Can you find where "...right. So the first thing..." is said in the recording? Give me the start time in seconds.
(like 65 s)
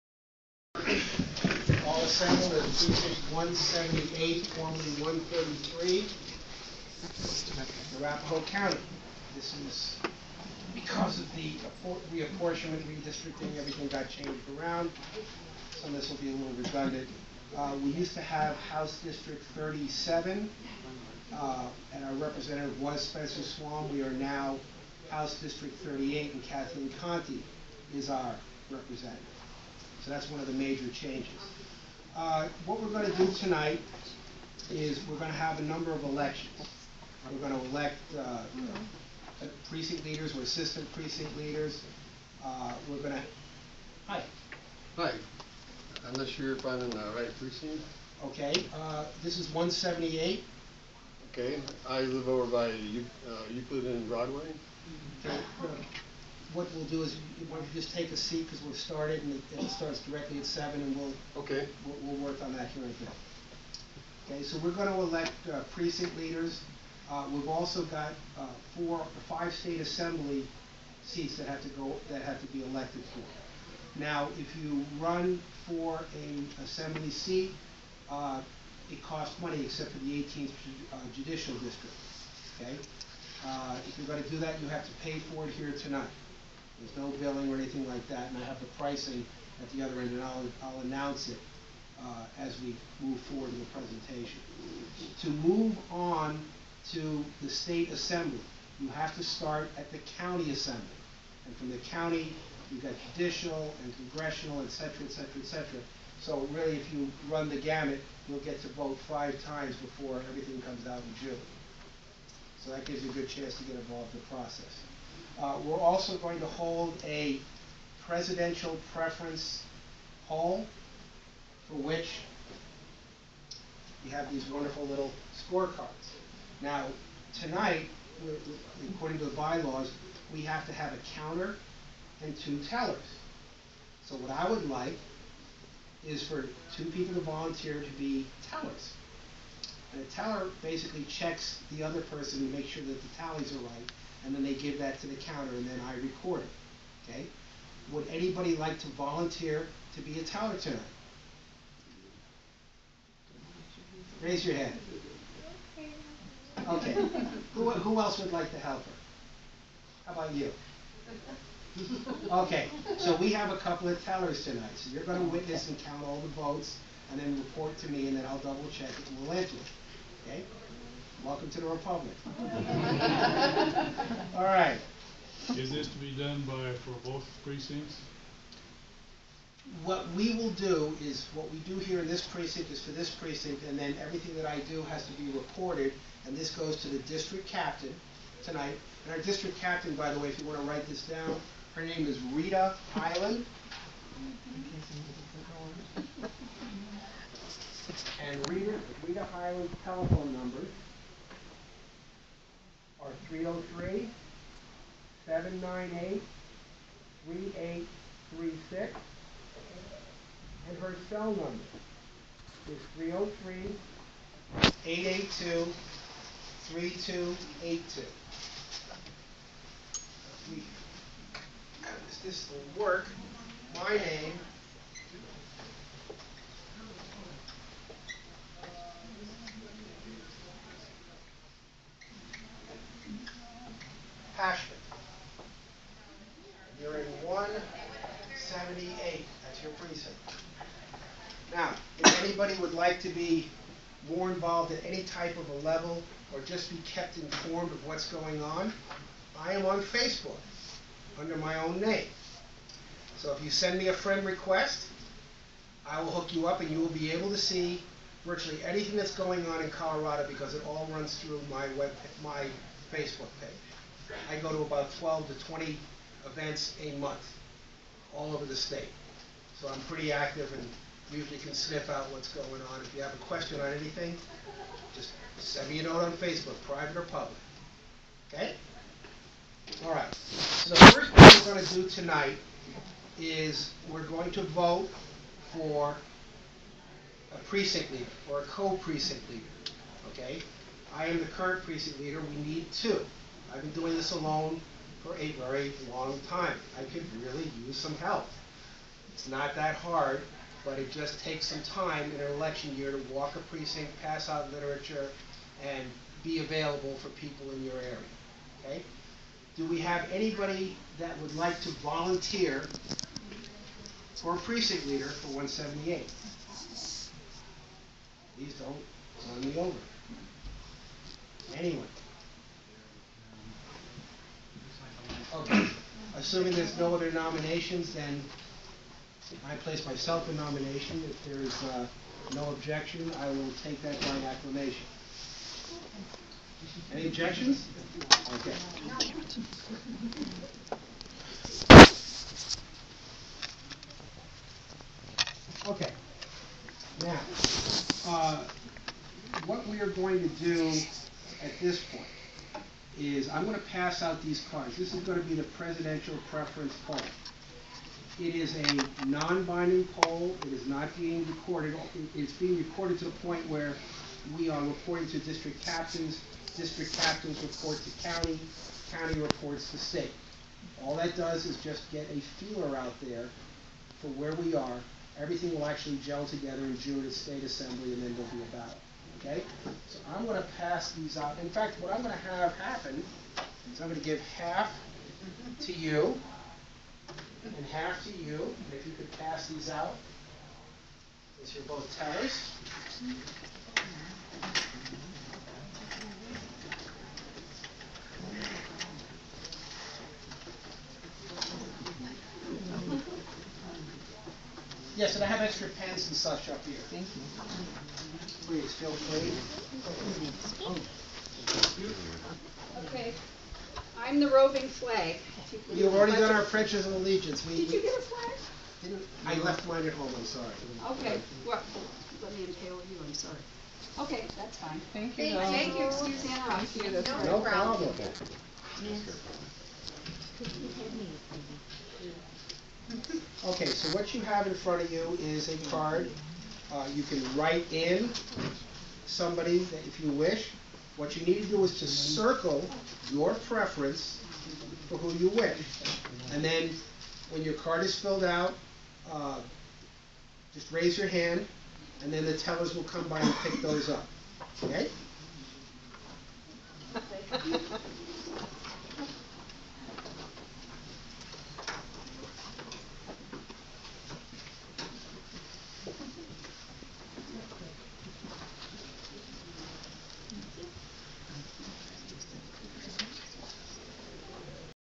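279 s.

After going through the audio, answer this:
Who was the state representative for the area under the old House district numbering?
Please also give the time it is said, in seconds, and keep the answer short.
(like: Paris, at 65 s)
Spencer Swalm, at 23 s.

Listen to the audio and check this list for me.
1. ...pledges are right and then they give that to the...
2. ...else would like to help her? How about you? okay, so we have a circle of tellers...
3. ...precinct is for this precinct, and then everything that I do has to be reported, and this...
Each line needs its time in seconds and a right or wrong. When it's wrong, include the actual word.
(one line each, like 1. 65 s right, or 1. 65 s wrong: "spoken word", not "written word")
1. 143 s wrong: "tallies", not "pledges"
2. 157 s wrong: "couple", not "circle"
3. 182 s right.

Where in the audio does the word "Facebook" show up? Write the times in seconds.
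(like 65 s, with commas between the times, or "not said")
249 s, 262 s, 276 s.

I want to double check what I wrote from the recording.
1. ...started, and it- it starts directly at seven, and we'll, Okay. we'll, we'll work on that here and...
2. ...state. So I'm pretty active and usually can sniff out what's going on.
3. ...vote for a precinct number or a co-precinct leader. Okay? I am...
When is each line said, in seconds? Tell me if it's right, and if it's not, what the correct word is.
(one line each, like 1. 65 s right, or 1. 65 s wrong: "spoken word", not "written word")
1. 58 s right
2. 268 s right
3. 284 s wrong: "leader", not "number".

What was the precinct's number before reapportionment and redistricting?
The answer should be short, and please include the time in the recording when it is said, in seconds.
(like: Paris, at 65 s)
133, at 5 s.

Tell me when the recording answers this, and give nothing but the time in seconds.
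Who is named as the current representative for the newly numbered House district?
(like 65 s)
26 s.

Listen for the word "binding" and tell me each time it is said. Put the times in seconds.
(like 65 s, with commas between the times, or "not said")
359 s.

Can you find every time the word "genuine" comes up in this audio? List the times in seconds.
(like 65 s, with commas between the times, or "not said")
not said.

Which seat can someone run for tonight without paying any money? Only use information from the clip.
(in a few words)
18th judicial district.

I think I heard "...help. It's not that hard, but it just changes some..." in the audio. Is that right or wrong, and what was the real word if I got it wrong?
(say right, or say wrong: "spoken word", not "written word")
wrong: "takes", not "changes".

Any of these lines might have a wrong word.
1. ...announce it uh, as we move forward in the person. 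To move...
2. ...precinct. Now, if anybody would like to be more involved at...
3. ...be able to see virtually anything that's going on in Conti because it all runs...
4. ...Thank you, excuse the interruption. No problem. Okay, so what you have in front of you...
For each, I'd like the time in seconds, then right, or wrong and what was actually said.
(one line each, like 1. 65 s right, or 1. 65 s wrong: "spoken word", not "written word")
1. 90 s wrong: "presentation", not "person"
2. 239 s right
3. 256 s wrong: "Colorado", not "Conti"
4. 425 s right.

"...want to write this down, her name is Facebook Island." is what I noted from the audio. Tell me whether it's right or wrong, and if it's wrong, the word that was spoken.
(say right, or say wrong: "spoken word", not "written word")
wrong: "Rita", not "Facebook".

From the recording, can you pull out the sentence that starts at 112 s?
So that gives you a good chance to get involved in the process.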